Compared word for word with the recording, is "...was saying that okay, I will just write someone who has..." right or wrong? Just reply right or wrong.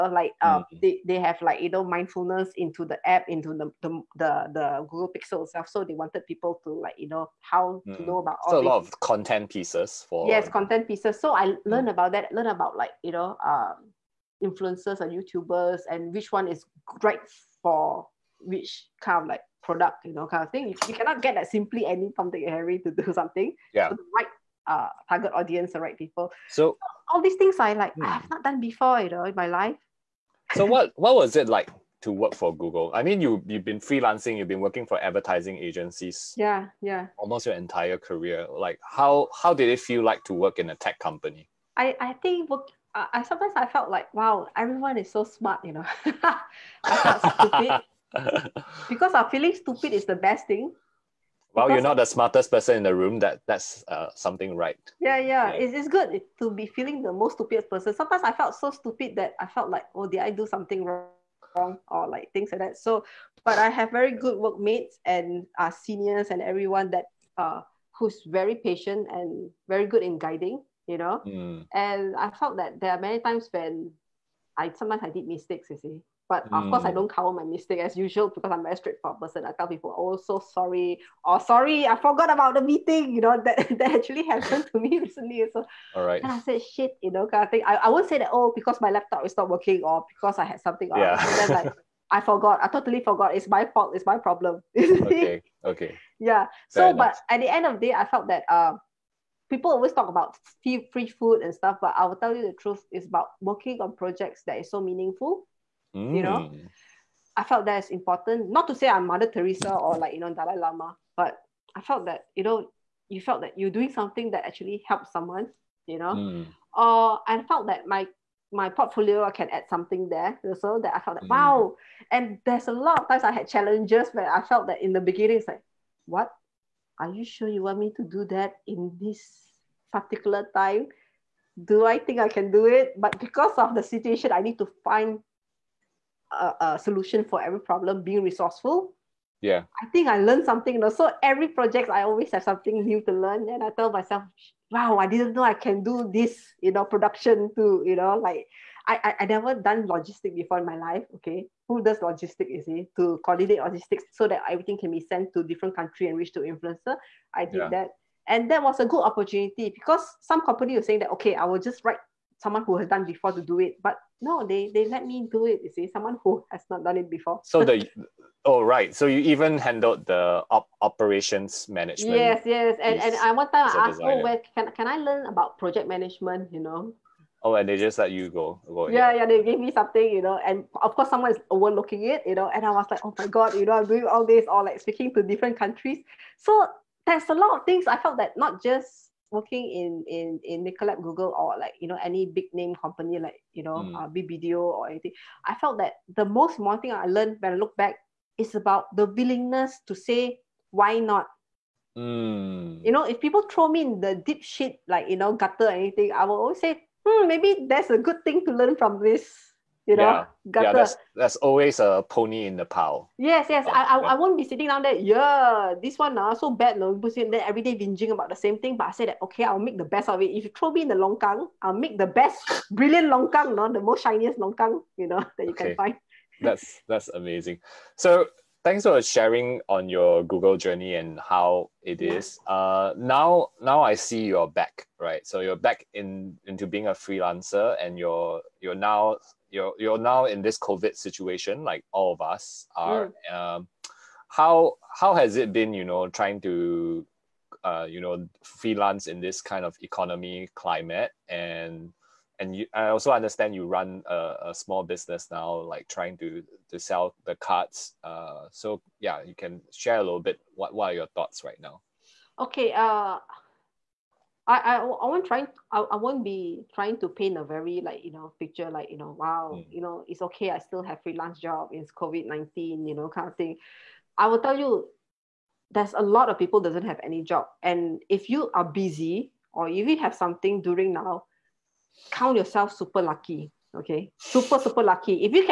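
right.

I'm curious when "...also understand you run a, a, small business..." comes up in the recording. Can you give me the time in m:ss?
4:12.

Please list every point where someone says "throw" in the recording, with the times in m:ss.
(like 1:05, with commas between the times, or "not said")
3:23, 3:40.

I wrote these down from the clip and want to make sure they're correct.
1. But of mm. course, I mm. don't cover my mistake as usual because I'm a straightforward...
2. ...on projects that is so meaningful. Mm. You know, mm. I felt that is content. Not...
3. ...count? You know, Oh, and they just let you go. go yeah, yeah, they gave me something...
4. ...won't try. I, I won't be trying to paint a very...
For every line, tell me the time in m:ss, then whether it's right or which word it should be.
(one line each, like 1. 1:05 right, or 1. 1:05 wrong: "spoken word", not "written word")
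1. 1:16 right
2. 1:43 wrong: "important", not "content"
3. 2:55 wrong: "management", not "count"
4. 4:25 right.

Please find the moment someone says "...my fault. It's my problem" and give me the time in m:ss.
1:33.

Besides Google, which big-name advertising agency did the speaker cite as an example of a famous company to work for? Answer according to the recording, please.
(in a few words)
BBDO.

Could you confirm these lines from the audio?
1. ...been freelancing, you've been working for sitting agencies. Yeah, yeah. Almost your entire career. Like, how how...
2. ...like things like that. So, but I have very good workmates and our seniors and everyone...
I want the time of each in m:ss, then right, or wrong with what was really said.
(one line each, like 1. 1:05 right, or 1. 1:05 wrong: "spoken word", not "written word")
1. 0:33 wrong: "advertising", not "sitting"
2. 1:02 right.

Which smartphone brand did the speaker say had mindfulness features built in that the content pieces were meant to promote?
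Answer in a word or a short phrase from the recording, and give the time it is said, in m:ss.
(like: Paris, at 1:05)
Google Pixel, at 0:04.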